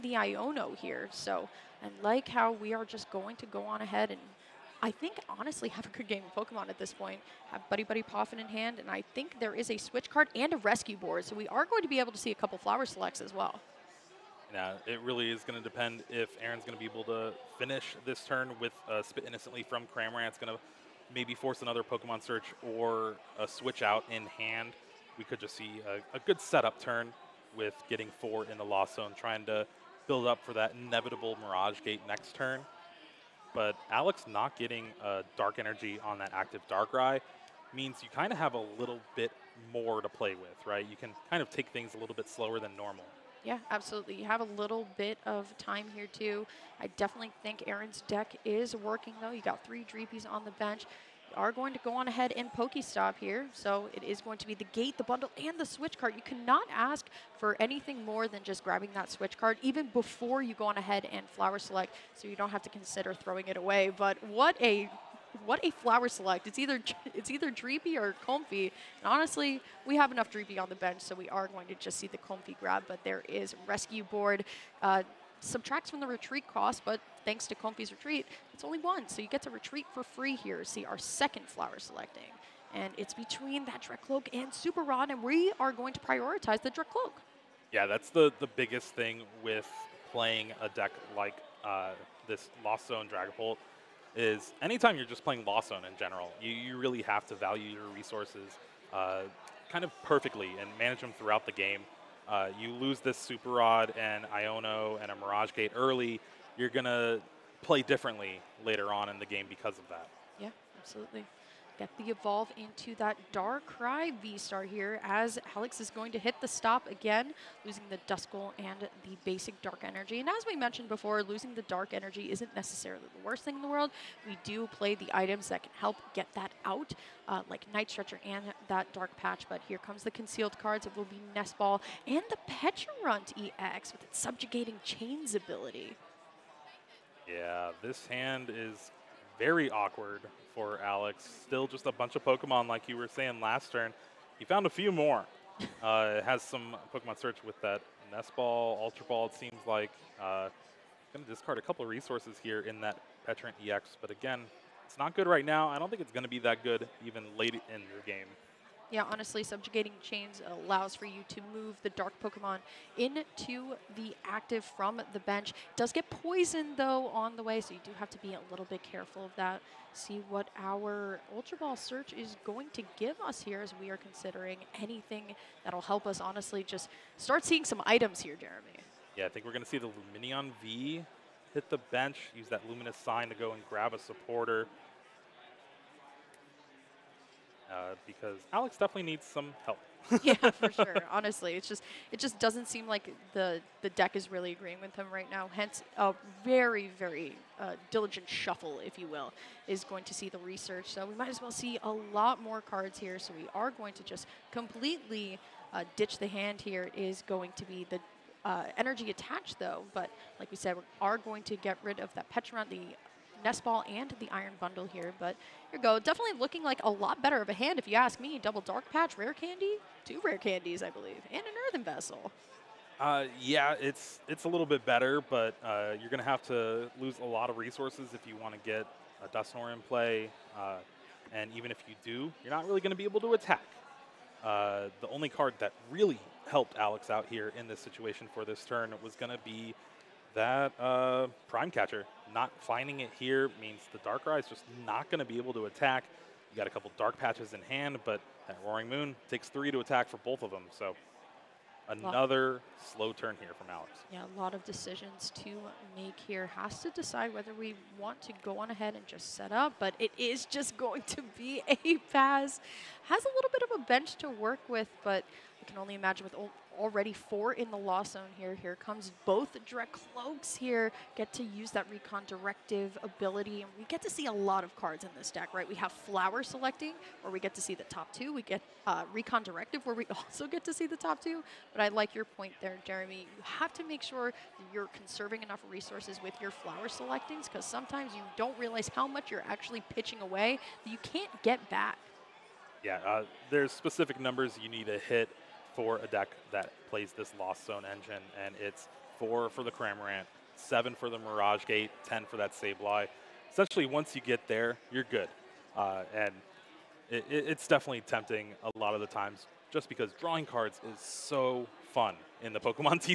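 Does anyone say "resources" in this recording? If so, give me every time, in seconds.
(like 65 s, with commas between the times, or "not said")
97 s, 151 s, 227 s, 285 s.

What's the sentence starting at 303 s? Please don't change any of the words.
Essentially, once you get there, you're good.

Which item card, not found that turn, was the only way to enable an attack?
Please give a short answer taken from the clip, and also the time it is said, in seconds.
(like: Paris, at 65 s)
Prime Catcher, at 241 s.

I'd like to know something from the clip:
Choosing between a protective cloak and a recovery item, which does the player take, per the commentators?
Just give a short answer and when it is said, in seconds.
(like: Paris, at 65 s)
the cloak, at 85 s.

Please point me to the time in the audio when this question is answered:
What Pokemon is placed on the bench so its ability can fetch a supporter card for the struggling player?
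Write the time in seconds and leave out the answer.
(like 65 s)
180 s.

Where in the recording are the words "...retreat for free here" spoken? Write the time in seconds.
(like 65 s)
79 s.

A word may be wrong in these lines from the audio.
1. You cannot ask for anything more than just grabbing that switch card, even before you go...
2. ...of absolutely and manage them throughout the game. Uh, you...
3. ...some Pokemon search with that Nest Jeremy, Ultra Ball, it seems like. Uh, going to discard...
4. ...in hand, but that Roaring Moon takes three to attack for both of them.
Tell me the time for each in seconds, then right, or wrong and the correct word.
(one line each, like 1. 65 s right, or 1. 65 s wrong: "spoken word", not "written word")
1. 56 s right
2. 99 s wrong: "perfectly", not "absolutely"
3. 146 s wrong: "Ball", not "Jeremy"
4. 247 s right.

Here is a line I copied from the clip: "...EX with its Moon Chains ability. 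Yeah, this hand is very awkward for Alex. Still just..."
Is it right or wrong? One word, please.
wrong.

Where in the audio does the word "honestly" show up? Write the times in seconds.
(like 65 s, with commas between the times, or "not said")
5 s, 69 s, 159 s, 176 s, 191 s.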